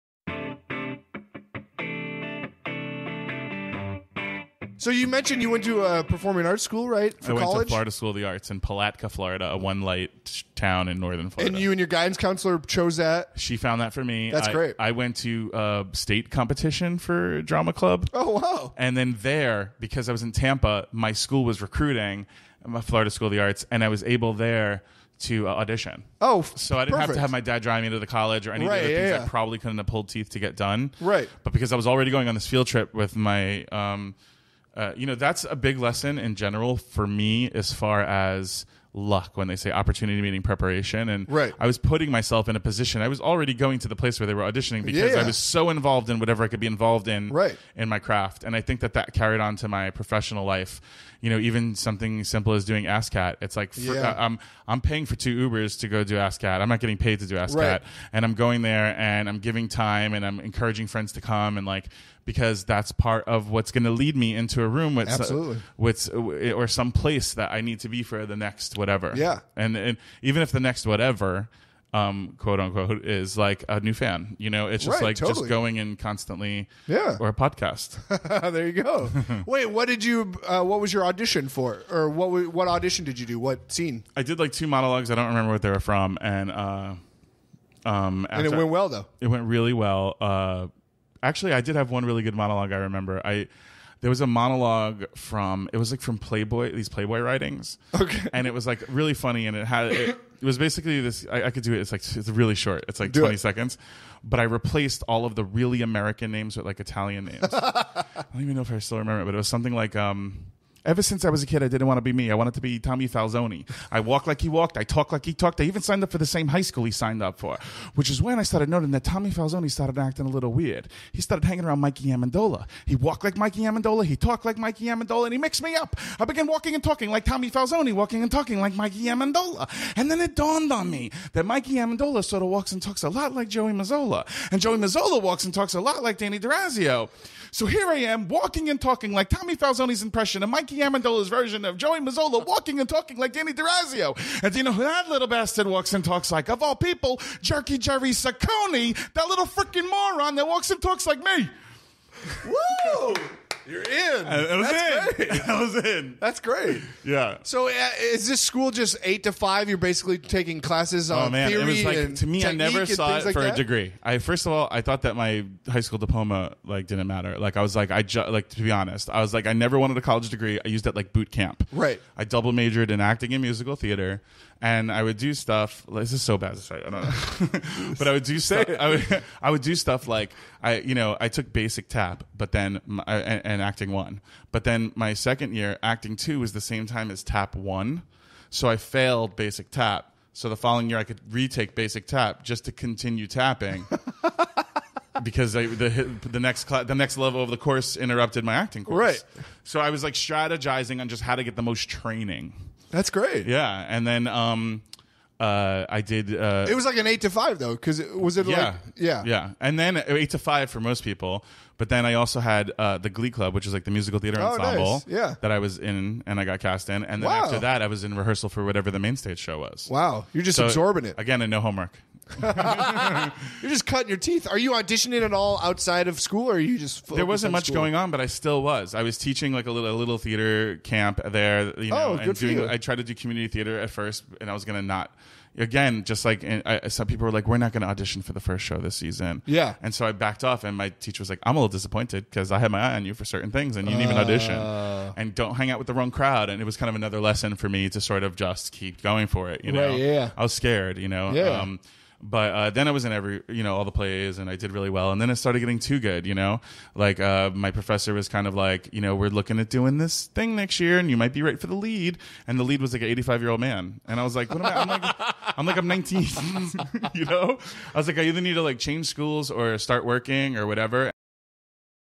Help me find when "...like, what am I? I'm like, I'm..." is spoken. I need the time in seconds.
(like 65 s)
264 s.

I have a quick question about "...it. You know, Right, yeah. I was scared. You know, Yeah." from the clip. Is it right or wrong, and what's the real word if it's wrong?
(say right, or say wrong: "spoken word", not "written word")
right.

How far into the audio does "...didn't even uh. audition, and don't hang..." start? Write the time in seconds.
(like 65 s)
243 s.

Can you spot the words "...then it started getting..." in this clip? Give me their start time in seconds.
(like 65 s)
255 s.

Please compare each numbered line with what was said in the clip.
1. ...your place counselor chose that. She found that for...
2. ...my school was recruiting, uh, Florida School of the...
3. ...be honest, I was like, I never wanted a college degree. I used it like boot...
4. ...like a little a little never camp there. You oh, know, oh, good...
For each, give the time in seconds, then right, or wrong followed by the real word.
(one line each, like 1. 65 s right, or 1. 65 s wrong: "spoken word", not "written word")
1. 11 s wrong: "guidance", not "place"
2. 20 s right
3. 168 s right
4. 229 s wrong: "theater", not "never".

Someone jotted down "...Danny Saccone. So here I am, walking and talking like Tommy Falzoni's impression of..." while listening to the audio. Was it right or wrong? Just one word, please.
wrong.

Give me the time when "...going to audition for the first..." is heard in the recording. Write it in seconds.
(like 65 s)
237 s.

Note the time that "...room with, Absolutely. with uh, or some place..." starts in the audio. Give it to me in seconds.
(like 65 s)
64 s.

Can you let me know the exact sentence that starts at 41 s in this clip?
i was putting myself in a position i was already going to the place where they were auditioning because yeah.